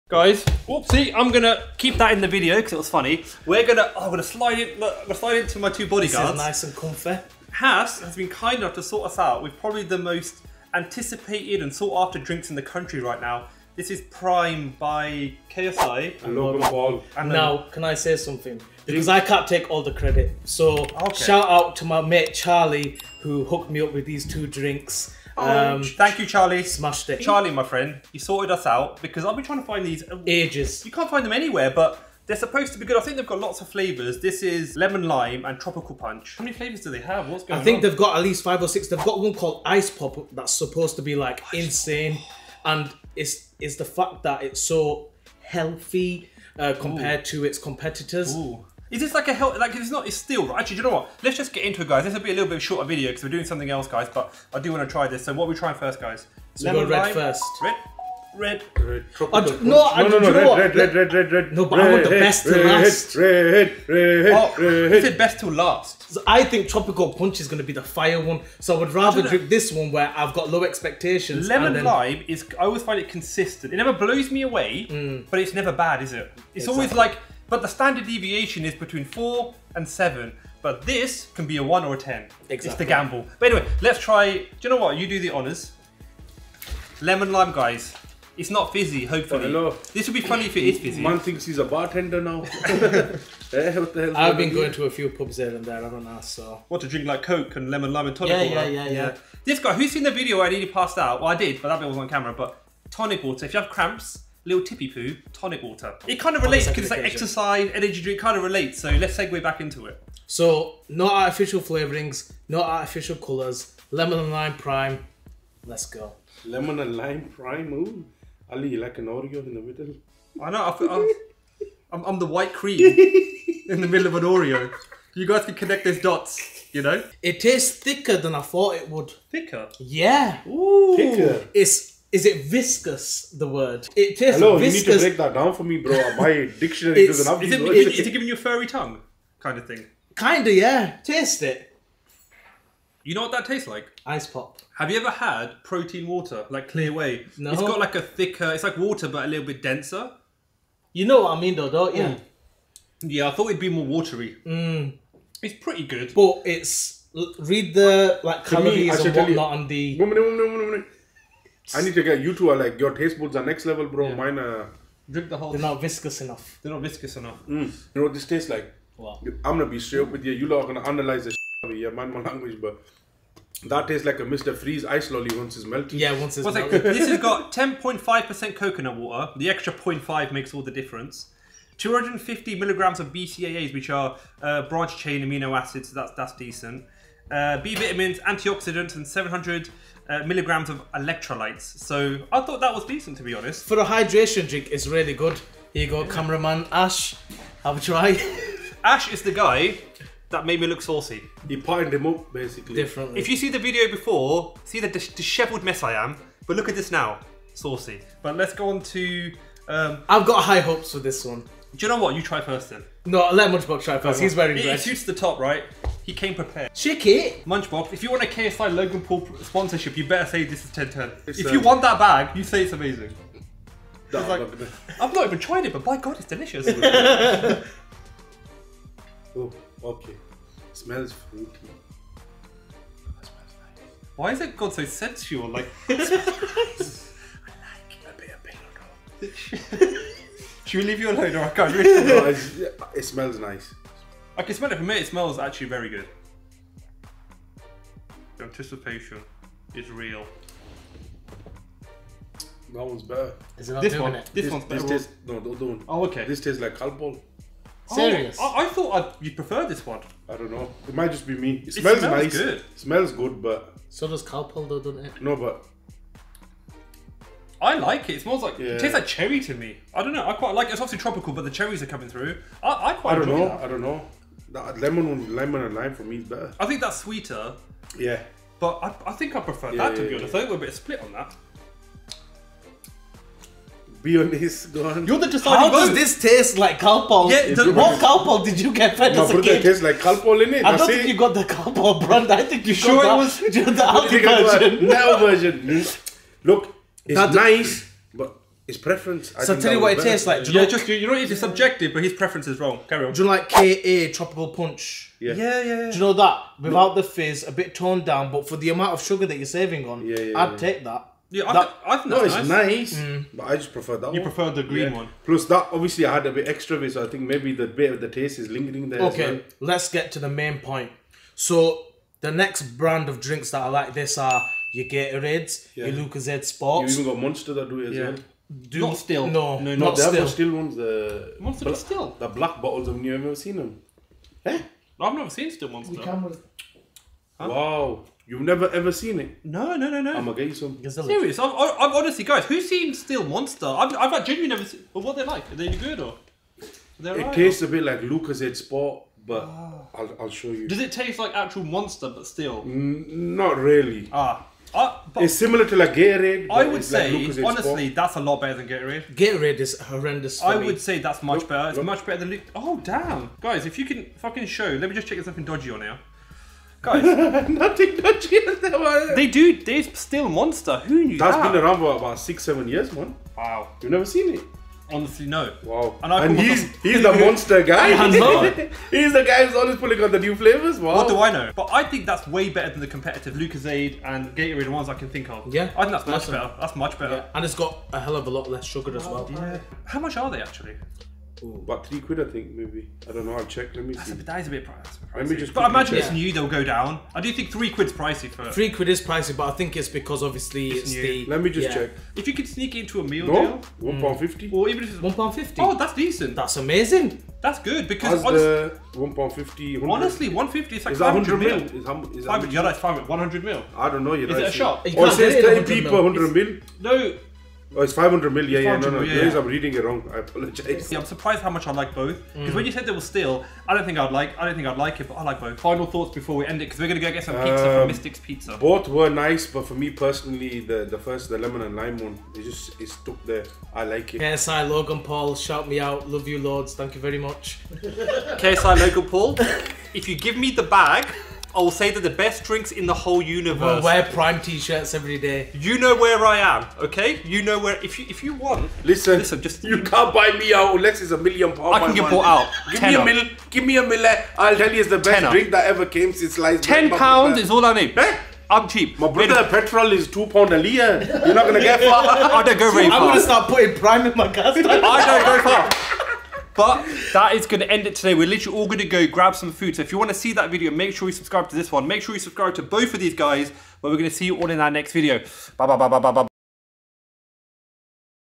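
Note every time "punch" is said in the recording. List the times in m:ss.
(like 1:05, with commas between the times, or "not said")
0:35, 1:07, 5:04.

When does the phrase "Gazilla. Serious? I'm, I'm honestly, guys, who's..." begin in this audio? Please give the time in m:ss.
5:40.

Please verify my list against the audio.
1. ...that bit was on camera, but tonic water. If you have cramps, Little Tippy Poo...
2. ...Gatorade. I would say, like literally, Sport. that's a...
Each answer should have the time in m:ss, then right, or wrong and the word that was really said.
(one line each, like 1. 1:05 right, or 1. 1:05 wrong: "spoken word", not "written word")
1. 1:41 right
2. 5:55 wrong: "honestly", not "literally".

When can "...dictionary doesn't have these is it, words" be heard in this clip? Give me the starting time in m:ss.
2:16.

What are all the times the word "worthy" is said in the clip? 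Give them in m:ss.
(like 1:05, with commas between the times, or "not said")
not said.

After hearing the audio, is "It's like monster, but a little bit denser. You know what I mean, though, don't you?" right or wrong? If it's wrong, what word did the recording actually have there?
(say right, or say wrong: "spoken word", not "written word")
wrong: "water", not "monster".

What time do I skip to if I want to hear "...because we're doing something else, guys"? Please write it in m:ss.
0:53.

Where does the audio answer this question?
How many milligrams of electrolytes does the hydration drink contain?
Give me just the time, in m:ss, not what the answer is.
3:09.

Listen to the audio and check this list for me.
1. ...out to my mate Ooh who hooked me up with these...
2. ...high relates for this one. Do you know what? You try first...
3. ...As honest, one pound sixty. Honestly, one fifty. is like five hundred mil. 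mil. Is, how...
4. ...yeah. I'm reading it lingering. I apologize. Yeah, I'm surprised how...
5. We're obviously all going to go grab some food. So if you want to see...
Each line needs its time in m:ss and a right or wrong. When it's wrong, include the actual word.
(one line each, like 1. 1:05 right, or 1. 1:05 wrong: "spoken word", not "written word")
1. 0:21 wrong: "Charlie", not "Ooh"
2. 3:30 wrong: "hopes", not "relates"
3. 6:48 wrong: "fifty", not "sixty"
4. 6:59 wrong: "wrong", not "lingering"
5. 7:48 wrong: "literally", not "obviously".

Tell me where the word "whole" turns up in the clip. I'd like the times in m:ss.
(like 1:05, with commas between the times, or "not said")
2:45, 7:22.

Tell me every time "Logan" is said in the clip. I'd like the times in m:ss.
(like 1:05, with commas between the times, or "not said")
0:16, 3:38, 7:14, 7:18.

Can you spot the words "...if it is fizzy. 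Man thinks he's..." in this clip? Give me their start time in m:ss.
1:30.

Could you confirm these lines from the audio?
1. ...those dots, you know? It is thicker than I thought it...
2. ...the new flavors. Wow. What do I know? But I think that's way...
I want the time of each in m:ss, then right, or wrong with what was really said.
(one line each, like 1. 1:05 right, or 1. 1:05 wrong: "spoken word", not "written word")
1. 2:05 right
2. 6:20 right.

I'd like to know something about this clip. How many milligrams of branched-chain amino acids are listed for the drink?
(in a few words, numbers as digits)
250 milligrams.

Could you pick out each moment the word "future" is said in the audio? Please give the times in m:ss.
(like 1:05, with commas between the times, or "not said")
not said.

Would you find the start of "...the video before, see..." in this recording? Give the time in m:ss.
3:23.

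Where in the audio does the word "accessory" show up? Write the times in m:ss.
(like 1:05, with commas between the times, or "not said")
not said.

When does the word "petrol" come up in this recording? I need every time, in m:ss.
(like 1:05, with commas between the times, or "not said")
7:39.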